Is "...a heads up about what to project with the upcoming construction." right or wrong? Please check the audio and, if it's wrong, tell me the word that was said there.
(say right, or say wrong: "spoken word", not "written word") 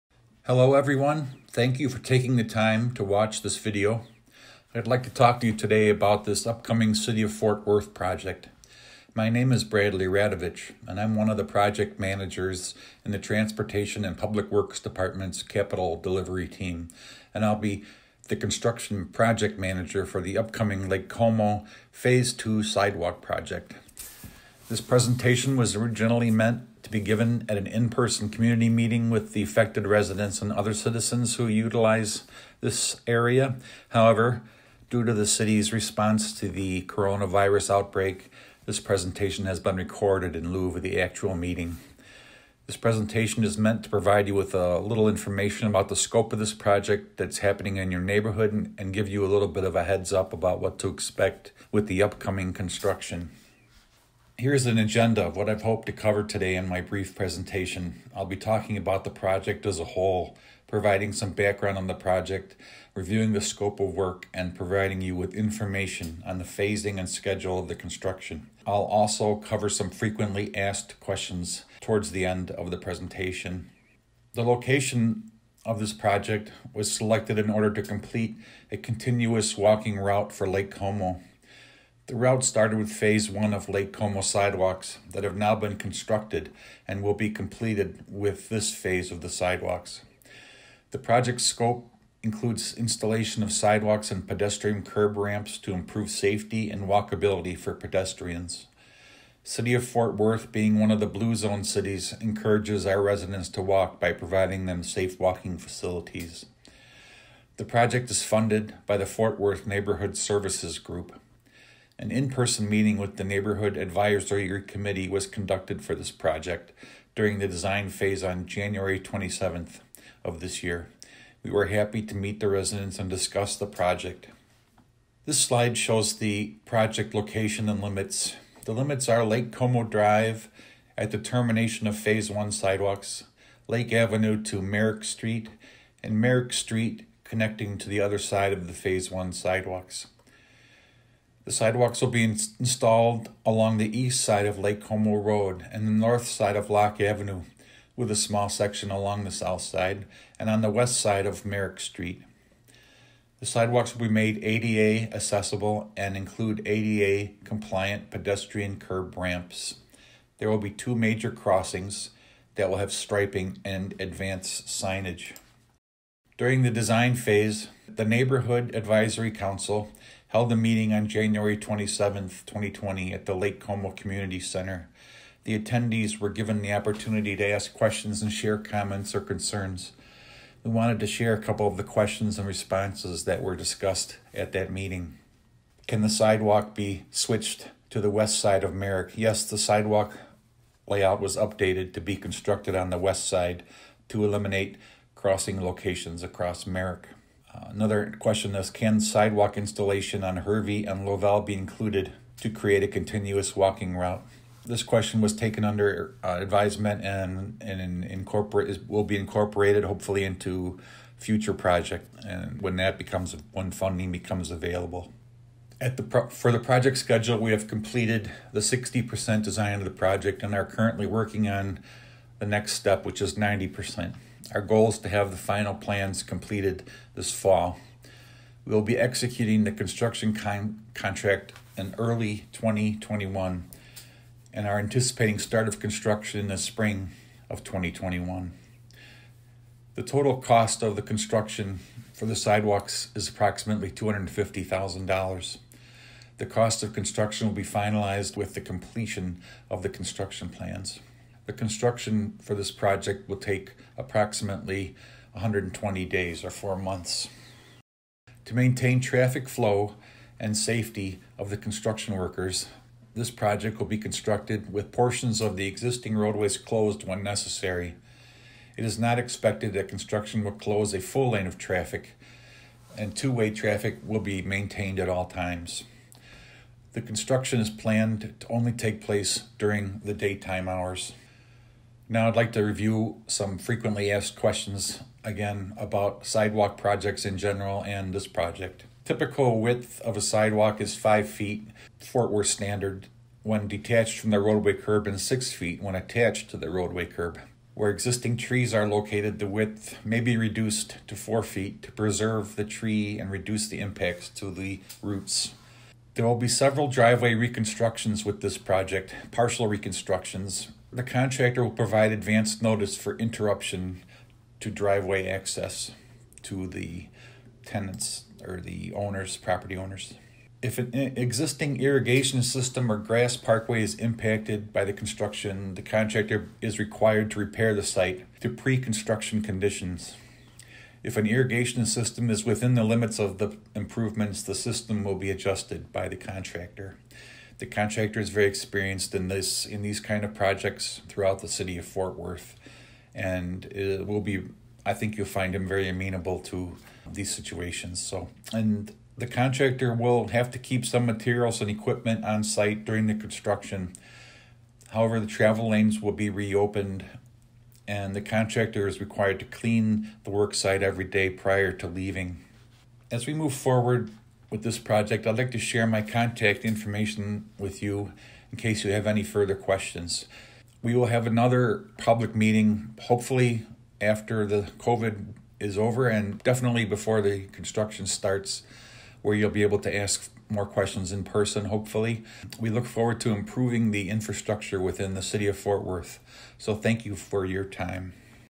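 wrong: "expect", not "project".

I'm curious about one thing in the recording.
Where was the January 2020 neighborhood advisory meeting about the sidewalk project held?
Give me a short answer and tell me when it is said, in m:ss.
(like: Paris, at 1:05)
Lake Como Community Center, at 2:53.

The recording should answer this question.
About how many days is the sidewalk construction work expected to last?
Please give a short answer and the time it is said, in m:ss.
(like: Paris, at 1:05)
120 days, at 4:15.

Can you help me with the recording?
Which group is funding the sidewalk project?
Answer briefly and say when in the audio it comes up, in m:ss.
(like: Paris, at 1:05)
Fort Worth Neighborhood Services Group, at 1:49.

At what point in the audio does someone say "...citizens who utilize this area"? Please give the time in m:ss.
0:30.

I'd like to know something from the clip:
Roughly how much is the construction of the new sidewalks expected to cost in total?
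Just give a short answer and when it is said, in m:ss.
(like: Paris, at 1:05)
$250,000, at 4:03.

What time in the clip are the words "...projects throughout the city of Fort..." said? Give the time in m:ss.
5:40.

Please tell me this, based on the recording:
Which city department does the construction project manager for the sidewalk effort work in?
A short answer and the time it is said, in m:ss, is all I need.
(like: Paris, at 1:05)
Transportation and Public Works, at 0:13.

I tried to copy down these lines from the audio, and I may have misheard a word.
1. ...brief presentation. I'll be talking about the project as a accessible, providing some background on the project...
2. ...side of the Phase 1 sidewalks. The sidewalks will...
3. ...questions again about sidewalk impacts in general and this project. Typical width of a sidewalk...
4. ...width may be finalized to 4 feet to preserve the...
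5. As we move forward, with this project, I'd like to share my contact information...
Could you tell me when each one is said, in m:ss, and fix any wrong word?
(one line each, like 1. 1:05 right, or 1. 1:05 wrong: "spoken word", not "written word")
1. 0:56 wrong: "whole", not "accessible"
2. 2:18 right
3. 4:44 wrong: "projects", not "impacts"
4. 4:59 wrong: "reduced", not "finalized"
5. 6:03 right.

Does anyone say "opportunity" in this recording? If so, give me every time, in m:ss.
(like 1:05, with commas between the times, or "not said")
2:56.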